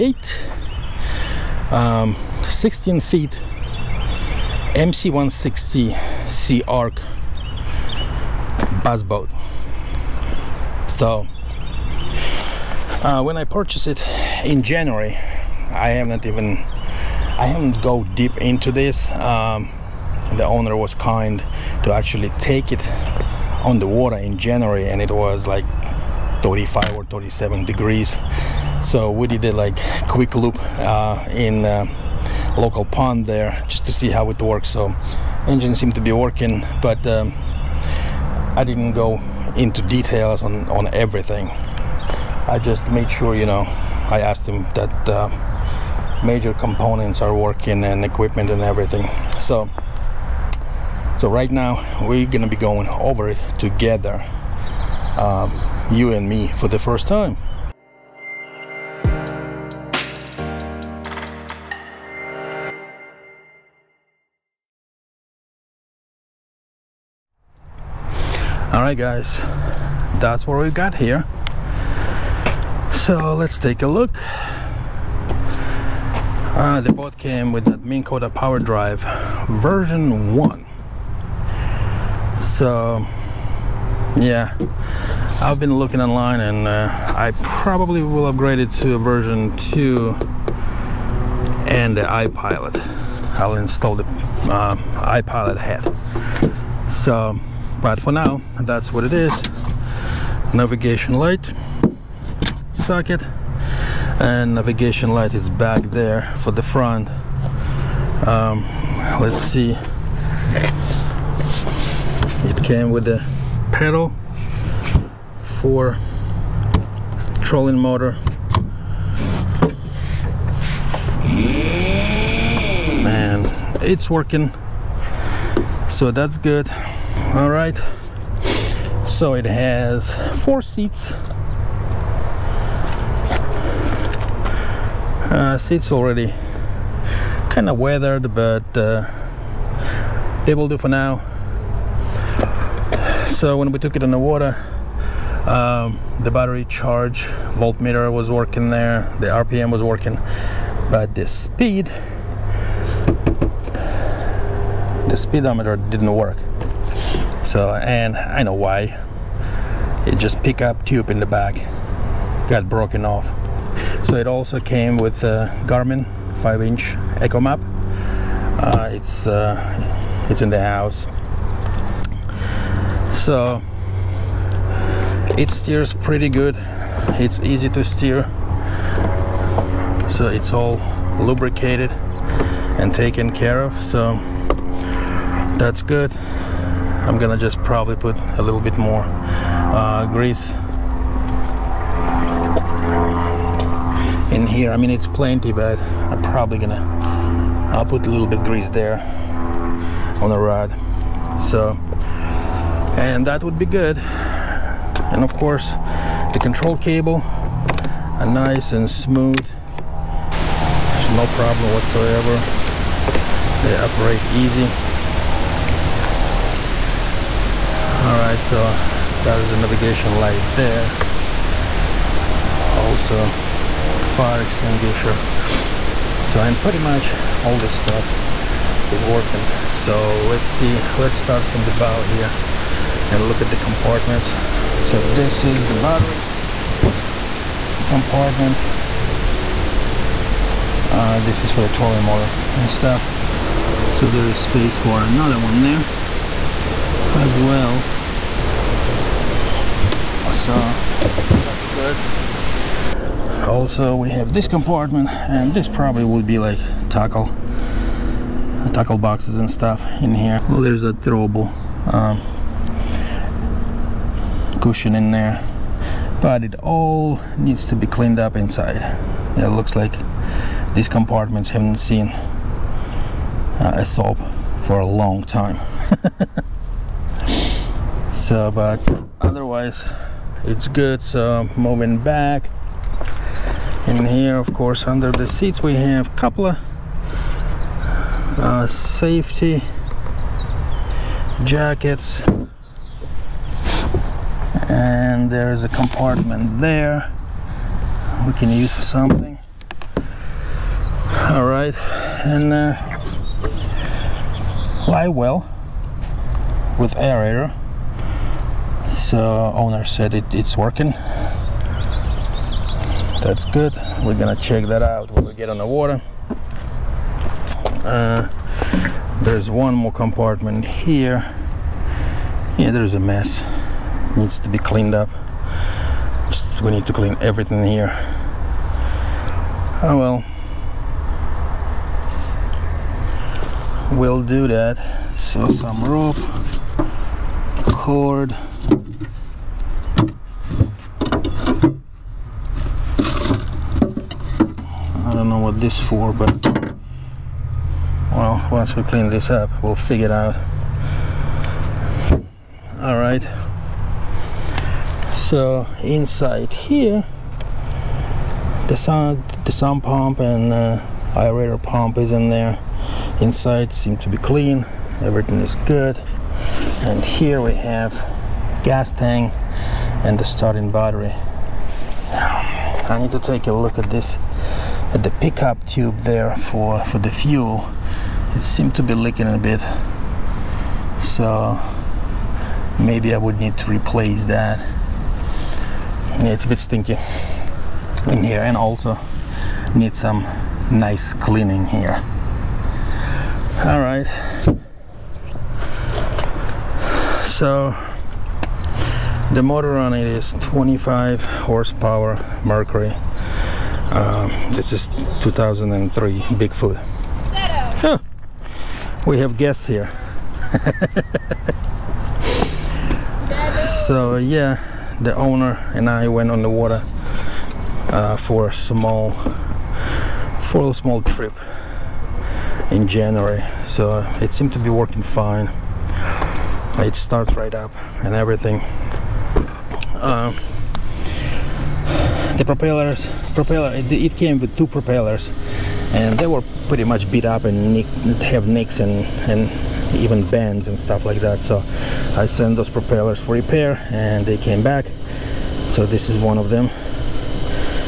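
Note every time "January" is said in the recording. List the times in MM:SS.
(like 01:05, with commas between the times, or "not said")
00:14, 00:24, 07:02.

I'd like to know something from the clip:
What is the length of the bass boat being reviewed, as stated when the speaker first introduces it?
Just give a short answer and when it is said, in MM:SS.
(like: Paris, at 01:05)
16 feet, at 00:02.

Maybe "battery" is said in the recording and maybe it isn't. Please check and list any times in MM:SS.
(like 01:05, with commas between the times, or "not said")
02:26, 03:55, 06:10.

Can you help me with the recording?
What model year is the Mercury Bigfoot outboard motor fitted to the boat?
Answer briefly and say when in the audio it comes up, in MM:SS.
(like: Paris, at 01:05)
2003, at 06:45.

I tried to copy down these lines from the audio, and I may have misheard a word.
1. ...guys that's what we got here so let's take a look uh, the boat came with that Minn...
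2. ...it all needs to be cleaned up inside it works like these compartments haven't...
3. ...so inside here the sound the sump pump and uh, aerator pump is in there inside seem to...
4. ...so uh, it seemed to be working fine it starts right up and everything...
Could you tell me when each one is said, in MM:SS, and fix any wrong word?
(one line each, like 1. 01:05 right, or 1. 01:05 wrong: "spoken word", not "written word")
1. 01:08 right
2. 04:26 wrong: "looks", not "works"
3. 05:55 right
4. 07:03 right.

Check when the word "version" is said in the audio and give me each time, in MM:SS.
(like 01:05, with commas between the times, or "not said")
01:19, 01:28.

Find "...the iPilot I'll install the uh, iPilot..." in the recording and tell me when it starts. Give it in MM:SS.
01:31.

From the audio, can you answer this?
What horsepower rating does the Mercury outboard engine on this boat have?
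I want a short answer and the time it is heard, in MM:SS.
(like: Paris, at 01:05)
25, at 06:40.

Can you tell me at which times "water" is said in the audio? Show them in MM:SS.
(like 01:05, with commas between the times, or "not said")
00:23, 02:24, 05:15, 06:56.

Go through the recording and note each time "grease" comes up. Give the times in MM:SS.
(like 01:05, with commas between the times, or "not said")
03:10, 03:18.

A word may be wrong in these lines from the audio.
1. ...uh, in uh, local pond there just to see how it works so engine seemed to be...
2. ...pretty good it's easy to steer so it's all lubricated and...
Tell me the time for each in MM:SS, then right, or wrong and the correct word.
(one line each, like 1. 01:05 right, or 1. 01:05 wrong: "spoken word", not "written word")
1. 00:30 right
2. 02:55 right.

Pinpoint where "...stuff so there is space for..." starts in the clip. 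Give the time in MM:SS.
04:02.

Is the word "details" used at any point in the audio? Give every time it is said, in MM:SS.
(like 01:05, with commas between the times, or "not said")
00:39.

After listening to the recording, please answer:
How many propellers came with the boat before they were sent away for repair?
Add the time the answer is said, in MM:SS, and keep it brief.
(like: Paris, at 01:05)
2, at 07:14.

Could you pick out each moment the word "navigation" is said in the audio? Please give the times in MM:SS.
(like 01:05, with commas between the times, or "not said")
01:40, 01:44, 03:39.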